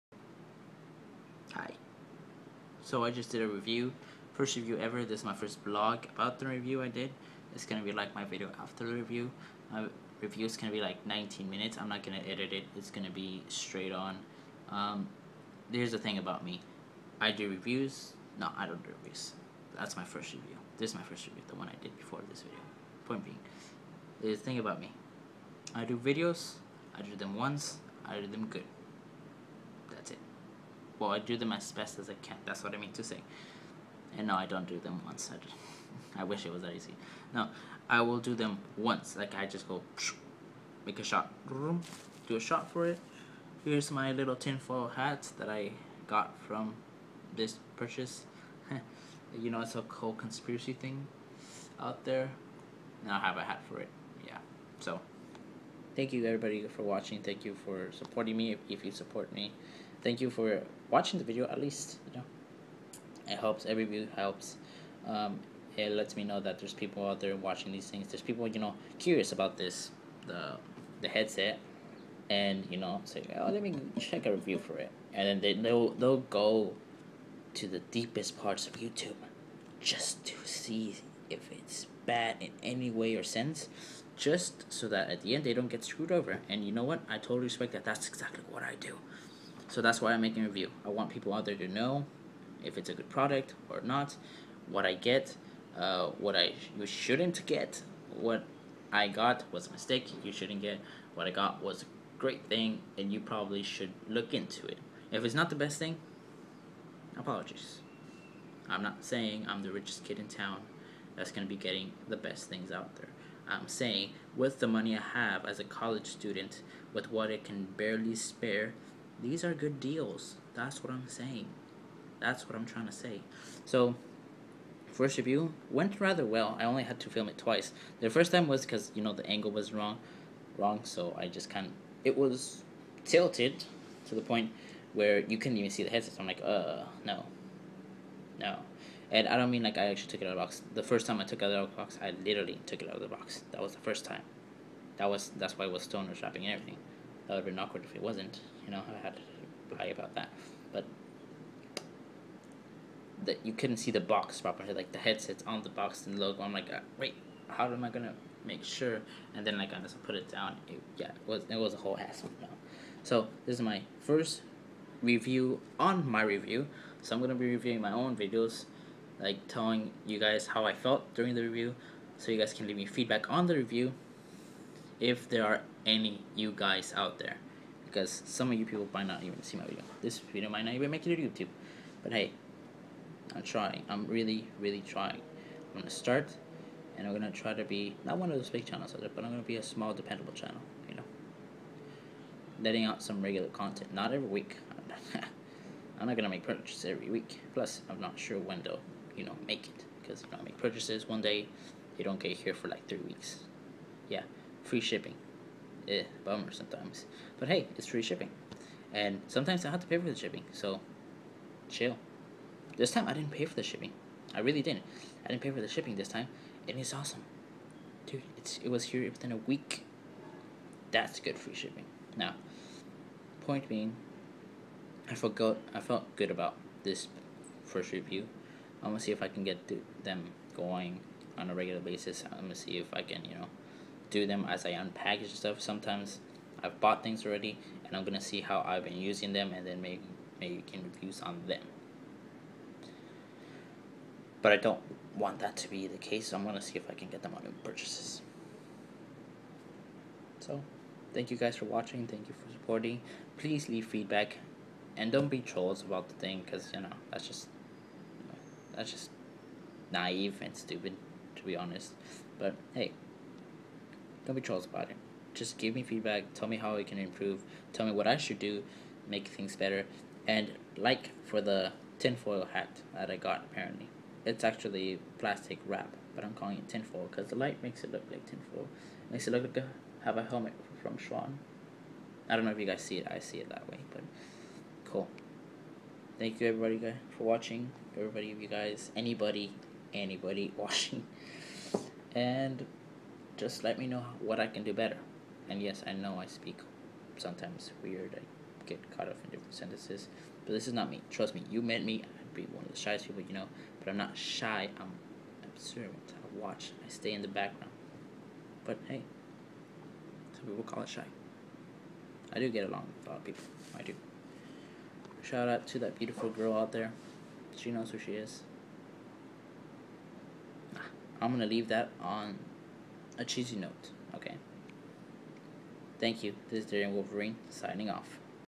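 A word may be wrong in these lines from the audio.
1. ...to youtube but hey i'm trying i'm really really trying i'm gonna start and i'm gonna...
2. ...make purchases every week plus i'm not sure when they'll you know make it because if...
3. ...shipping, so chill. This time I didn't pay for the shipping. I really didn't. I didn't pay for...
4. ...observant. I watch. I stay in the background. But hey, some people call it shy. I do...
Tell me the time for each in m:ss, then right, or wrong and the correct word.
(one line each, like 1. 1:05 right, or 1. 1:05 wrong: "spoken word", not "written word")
1. 3:01 right
2. 3:16 right
3. 3:30 right
4. 5:05 right.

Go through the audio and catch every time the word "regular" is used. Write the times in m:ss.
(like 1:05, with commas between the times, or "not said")
3:13, 3:51.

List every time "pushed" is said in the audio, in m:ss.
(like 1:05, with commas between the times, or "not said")
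not said.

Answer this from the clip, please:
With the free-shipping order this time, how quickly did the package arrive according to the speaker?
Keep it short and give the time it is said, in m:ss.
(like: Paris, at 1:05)
within a week, at 3:39.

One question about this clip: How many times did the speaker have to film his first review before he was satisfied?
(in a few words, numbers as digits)
twice.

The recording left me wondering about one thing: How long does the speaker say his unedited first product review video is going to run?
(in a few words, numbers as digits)
19 minutes.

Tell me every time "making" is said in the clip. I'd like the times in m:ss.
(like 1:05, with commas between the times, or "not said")
1:30, 4:00.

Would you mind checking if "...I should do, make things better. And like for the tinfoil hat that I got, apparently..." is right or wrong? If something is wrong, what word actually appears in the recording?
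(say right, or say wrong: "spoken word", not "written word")
right.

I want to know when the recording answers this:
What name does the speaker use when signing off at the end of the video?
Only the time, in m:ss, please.
5:26.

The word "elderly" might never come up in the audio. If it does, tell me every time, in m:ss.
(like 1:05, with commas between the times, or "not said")
not said.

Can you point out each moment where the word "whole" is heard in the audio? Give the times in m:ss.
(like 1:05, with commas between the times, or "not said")
0:49, 2:41.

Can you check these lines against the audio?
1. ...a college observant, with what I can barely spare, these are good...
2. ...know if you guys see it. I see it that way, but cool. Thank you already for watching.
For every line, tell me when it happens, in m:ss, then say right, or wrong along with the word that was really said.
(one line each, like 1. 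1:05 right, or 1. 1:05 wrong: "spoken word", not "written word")
1. 1:55 wrong: "student", not "observant"
2. 4:42 wrong: "everybody", not "already".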